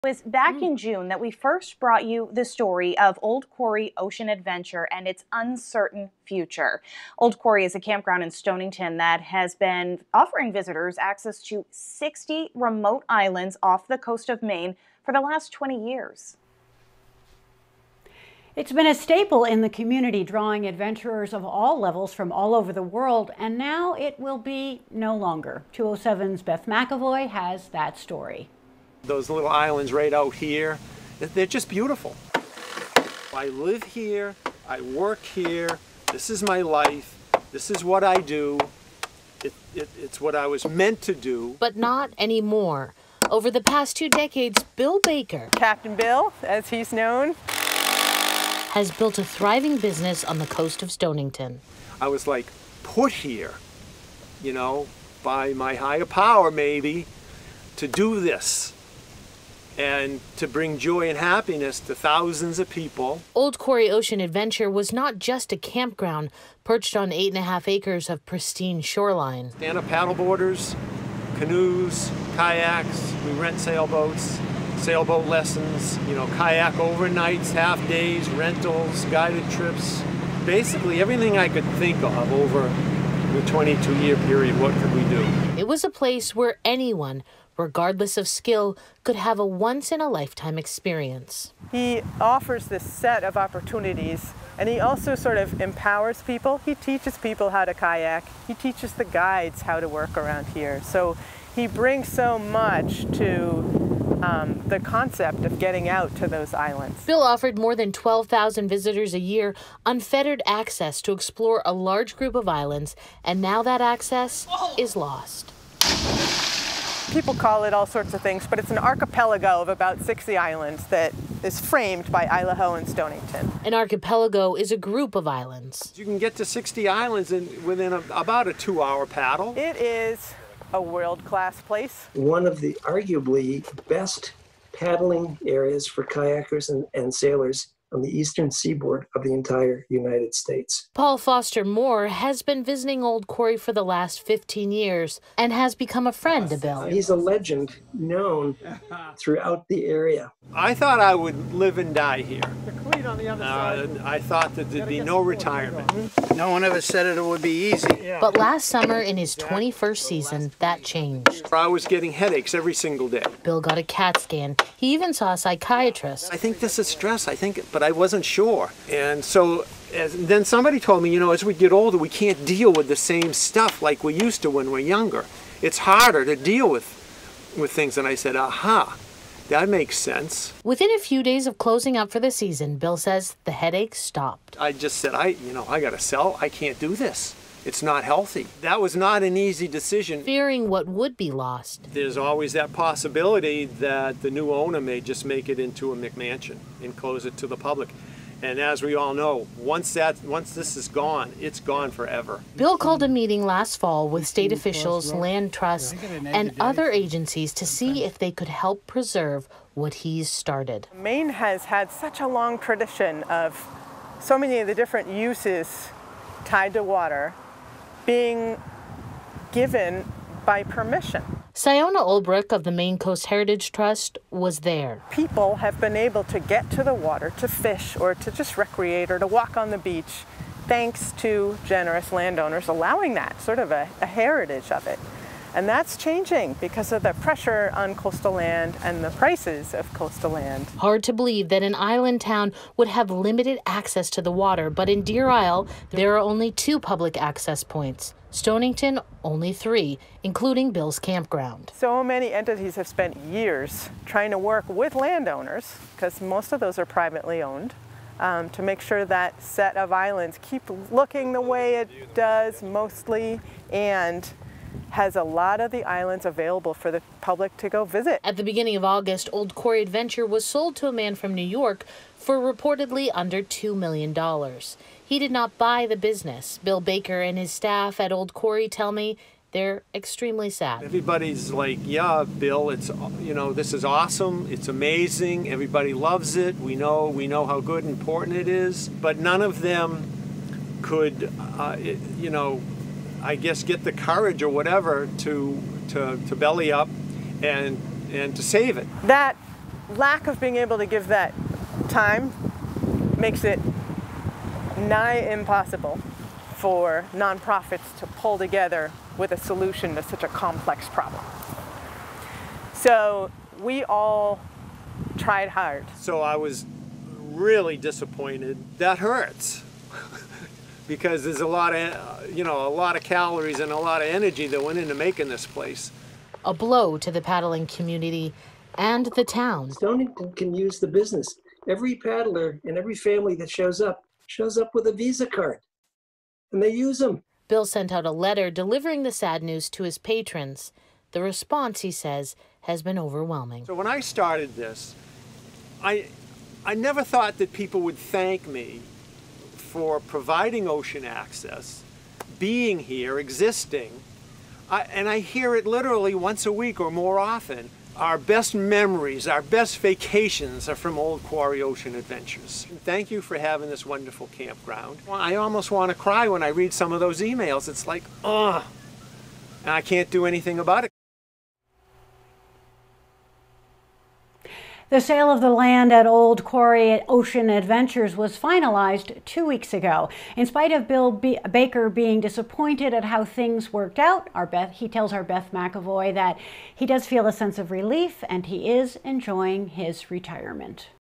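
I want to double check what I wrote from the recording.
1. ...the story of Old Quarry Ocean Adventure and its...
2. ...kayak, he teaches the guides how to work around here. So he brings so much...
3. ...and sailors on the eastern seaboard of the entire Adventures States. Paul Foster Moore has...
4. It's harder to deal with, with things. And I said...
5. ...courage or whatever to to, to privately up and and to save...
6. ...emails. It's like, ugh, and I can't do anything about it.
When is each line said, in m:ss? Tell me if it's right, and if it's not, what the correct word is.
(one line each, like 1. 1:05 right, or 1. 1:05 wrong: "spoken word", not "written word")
1. 0:02 right
2. 1:37 right
3. 2:16 wrong: "United", not "Adventures"
4. 2:55 right
5. 4:53 wrong: "belly", not "privately"
6. 6:07 right.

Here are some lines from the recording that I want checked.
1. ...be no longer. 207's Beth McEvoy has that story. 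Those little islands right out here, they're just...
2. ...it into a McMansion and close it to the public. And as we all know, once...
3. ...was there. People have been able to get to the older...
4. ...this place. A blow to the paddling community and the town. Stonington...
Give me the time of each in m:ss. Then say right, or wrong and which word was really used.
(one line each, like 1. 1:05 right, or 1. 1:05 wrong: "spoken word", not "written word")
1. 0:24 right
2. 3:15 right
3. 3:44 wrong: "water", not "older"
4. 5:25 right.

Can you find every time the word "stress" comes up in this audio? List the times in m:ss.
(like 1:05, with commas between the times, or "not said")
2:46.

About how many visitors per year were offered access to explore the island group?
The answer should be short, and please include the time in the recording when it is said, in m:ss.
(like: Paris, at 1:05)
12,000, at 1:47.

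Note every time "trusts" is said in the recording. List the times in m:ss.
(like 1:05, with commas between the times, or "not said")
3:25, 3:43.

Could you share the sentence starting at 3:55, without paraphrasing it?
And that's changing because of the pressure on coastal land and the prices of coastal land.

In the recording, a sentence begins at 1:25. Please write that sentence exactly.
It was a place where anyone regardless of skill, could have a once in a lifetime experience.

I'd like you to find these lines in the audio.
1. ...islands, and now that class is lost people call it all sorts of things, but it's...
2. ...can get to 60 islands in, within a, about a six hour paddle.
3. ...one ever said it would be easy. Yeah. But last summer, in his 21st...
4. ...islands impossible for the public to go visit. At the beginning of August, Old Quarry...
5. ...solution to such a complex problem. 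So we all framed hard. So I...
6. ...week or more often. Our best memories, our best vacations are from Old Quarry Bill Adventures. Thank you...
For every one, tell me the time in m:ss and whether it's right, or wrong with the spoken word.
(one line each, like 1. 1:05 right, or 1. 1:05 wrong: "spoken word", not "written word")
1. 1:52 wrong: "access", not "class"
2. 2:06 wrong: "two", not "six"
3. 2:36 right
4. 4:25 wrong: "available", not "impossible"
5. 5:09 wrong: "tried", not "framed"
6. 5:56 wrong: "Ocean", not "Bill".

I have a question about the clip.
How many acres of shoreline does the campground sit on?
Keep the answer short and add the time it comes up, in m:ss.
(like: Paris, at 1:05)
8.5, at 1:07.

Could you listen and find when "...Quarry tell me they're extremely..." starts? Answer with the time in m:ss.
4:38.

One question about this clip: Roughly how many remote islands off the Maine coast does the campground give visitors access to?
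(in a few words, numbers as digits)
60.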